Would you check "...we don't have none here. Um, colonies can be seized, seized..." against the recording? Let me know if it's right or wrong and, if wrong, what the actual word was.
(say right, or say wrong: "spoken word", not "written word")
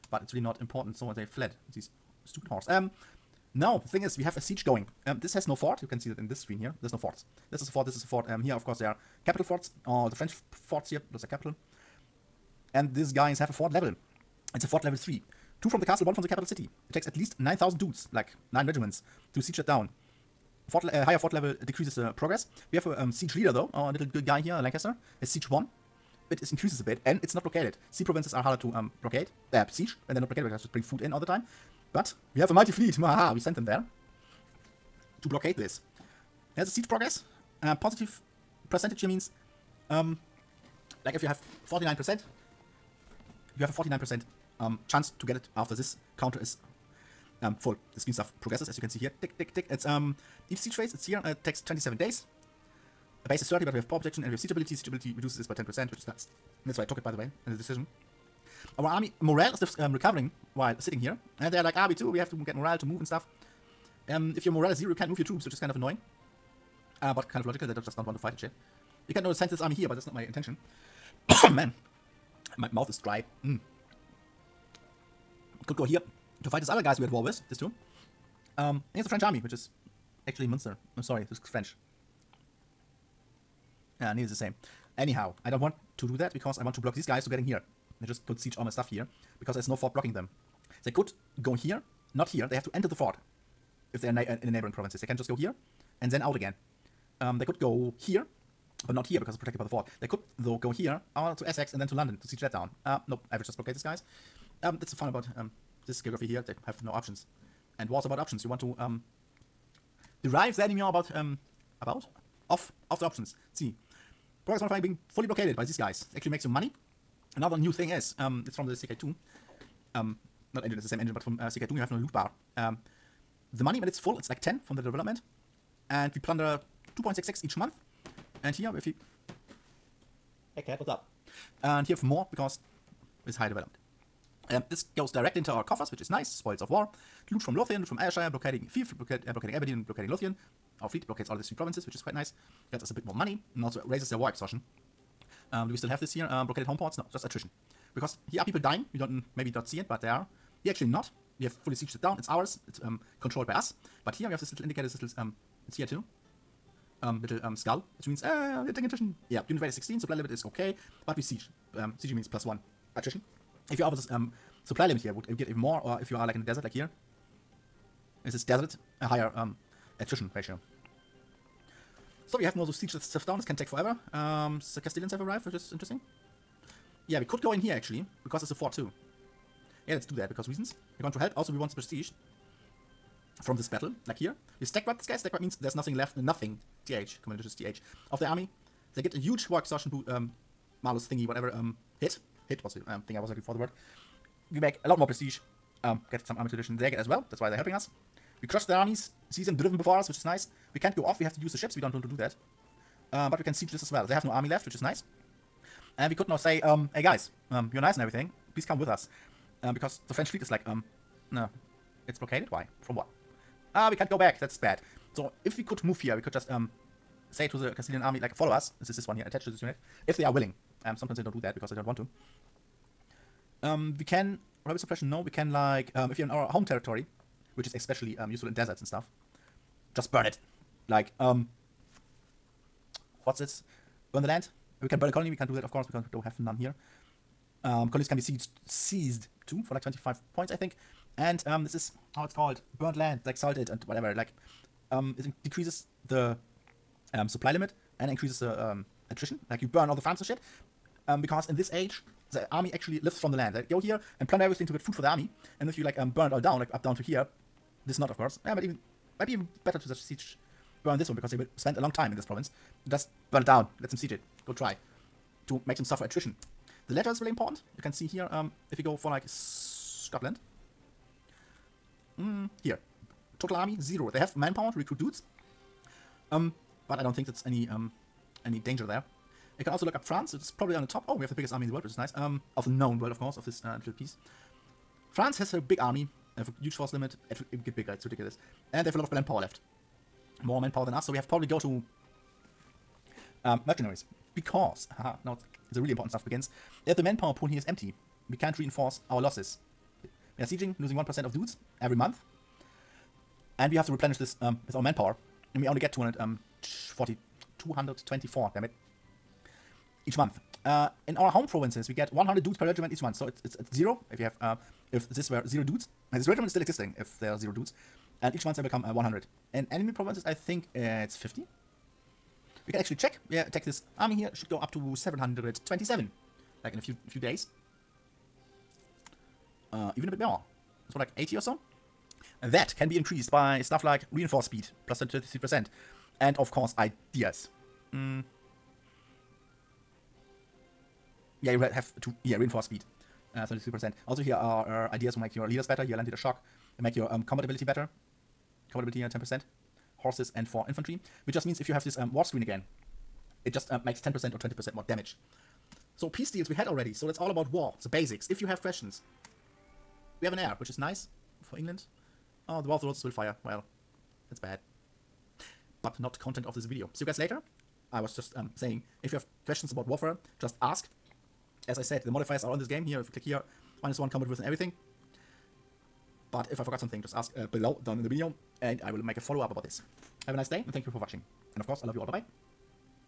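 right.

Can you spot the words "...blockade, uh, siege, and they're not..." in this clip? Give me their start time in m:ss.
0:29.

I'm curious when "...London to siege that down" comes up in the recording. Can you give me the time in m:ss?
1:41.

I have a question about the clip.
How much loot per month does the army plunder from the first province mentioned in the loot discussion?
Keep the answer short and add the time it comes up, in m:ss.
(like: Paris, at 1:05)
2.66, at 2:06.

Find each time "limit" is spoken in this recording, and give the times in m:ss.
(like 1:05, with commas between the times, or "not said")
2:40, 2:44, 4:07, 4:46.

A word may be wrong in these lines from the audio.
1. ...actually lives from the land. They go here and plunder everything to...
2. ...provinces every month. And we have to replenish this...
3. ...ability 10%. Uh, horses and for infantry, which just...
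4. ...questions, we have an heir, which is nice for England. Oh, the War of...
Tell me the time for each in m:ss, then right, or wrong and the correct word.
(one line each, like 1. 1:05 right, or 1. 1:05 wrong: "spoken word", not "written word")
1. 4:12 right
2. 5:01 wrong: "dudes", not "provinces"
3. 5:48 right
4. 5:58 right.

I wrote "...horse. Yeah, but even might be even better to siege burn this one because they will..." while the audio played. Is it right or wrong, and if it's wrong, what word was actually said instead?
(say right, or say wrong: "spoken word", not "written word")
wrong: "course", not "horse".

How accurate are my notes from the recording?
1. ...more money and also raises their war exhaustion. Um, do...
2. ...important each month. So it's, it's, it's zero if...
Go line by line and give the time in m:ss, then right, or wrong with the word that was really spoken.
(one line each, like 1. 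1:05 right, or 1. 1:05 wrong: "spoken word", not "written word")
1. 2:23 right
2. 5:12 wrong: "regiment", not "important".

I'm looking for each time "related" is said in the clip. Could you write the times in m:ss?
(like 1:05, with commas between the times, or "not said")
not said.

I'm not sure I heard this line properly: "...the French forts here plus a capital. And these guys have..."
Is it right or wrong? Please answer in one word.
right.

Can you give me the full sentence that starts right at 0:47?
The screen stuff progresses as you can see here.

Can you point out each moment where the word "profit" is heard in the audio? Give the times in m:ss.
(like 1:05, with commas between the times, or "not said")
not said.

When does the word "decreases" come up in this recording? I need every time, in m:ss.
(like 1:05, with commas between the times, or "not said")
0:21, 4:05.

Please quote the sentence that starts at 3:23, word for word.
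Um, but we can siege this as well.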